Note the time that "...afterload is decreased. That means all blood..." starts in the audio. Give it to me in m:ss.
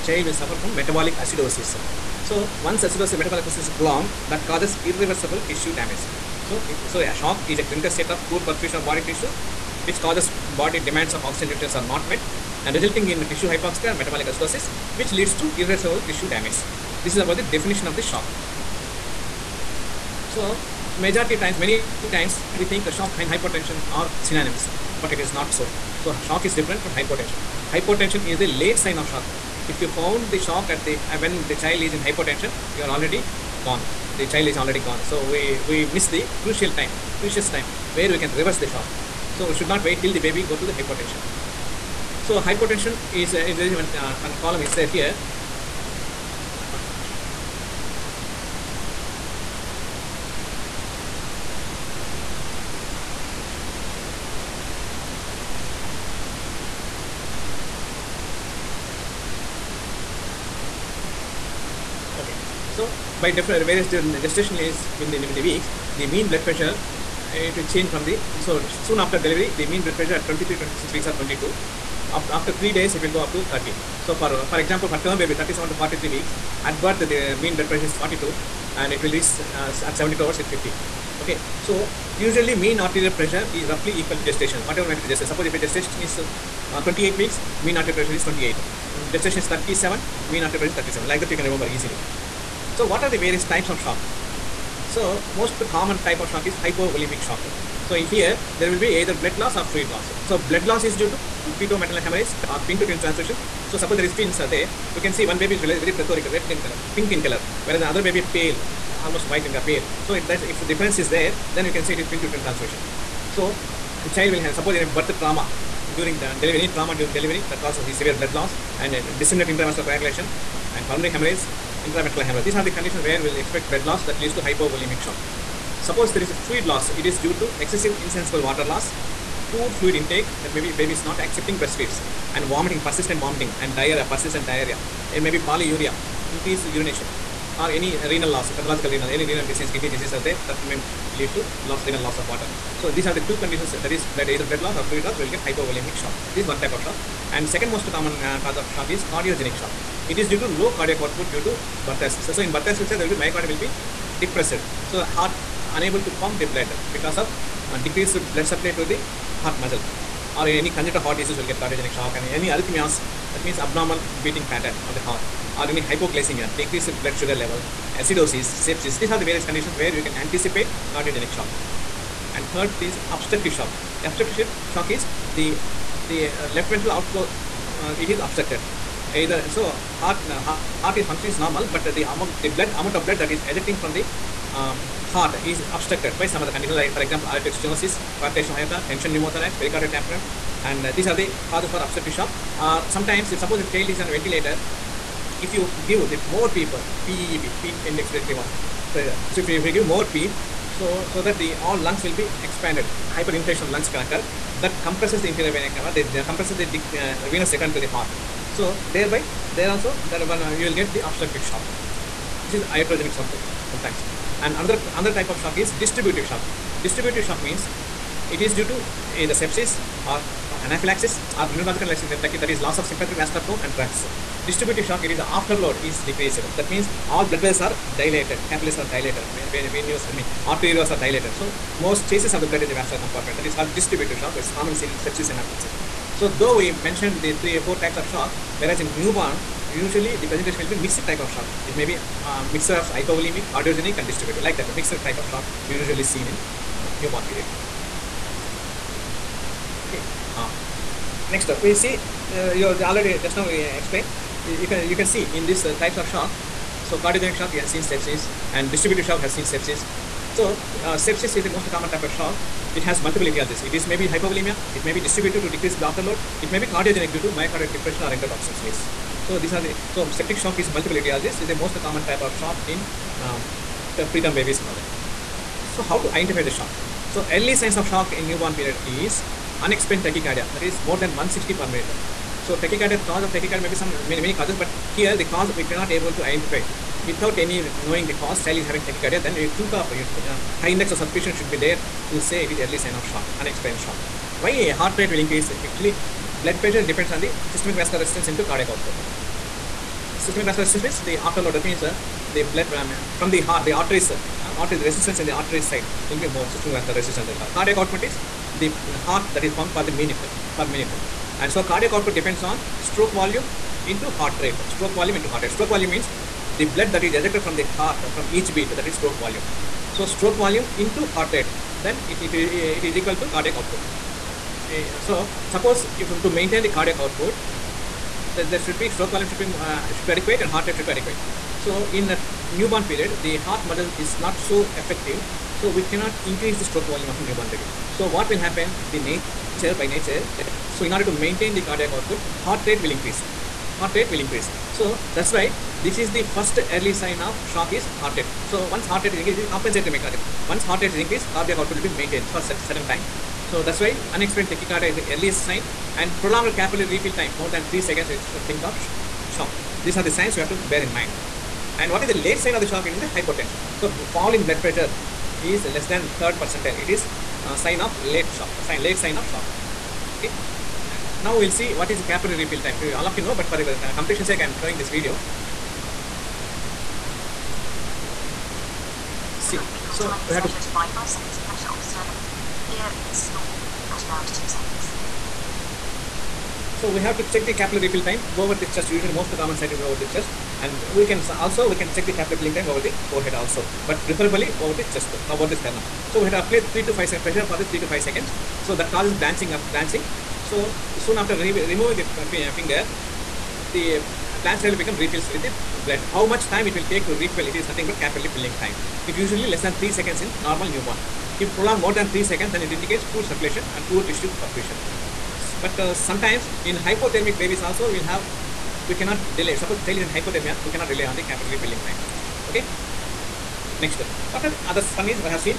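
3:45.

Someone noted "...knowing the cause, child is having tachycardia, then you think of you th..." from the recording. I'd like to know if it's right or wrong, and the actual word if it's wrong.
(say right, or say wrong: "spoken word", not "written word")
right.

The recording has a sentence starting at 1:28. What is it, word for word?
Um, gestation is 37, mean arterial pressure is 37.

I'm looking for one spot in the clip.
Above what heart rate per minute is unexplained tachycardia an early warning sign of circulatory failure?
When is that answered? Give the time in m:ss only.
4:41.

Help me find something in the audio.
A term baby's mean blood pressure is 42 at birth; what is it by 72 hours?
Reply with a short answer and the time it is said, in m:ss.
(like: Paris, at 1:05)
50, at 1:20.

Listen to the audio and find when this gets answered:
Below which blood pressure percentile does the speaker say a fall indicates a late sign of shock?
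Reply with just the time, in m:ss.
6:06.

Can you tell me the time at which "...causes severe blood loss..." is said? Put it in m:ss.
1:57.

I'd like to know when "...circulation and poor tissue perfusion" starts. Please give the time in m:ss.
6:53.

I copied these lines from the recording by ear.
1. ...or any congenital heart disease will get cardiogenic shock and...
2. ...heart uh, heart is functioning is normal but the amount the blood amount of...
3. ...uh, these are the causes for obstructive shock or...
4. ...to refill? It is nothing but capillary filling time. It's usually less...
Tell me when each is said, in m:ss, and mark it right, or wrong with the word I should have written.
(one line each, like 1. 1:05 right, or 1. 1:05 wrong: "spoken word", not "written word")
1. 2:40 right
2. 2:59 right
3. 3:10 right
4. 6:47 right.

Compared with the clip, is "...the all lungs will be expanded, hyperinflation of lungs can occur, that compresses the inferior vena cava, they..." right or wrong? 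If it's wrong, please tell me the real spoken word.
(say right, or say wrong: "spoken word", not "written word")
right.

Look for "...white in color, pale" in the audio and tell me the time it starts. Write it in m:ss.
1:49.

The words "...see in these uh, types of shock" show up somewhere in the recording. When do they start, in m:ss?
4:15.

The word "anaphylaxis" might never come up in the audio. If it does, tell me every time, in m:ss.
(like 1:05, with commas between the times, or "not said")
3:40, 3:55.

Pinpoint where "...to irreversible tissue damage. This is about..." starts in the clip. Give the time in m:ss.
0:15.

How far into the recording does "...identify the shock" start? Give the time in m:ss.
4:36.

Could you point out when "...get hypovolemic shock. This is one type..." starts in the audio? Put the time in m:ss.
2:25.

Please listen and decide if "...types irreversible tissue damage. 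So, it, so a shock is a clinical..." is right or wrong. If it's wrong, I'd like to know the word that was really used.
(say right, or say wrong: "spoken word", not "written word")
wrong: "causes", not "types".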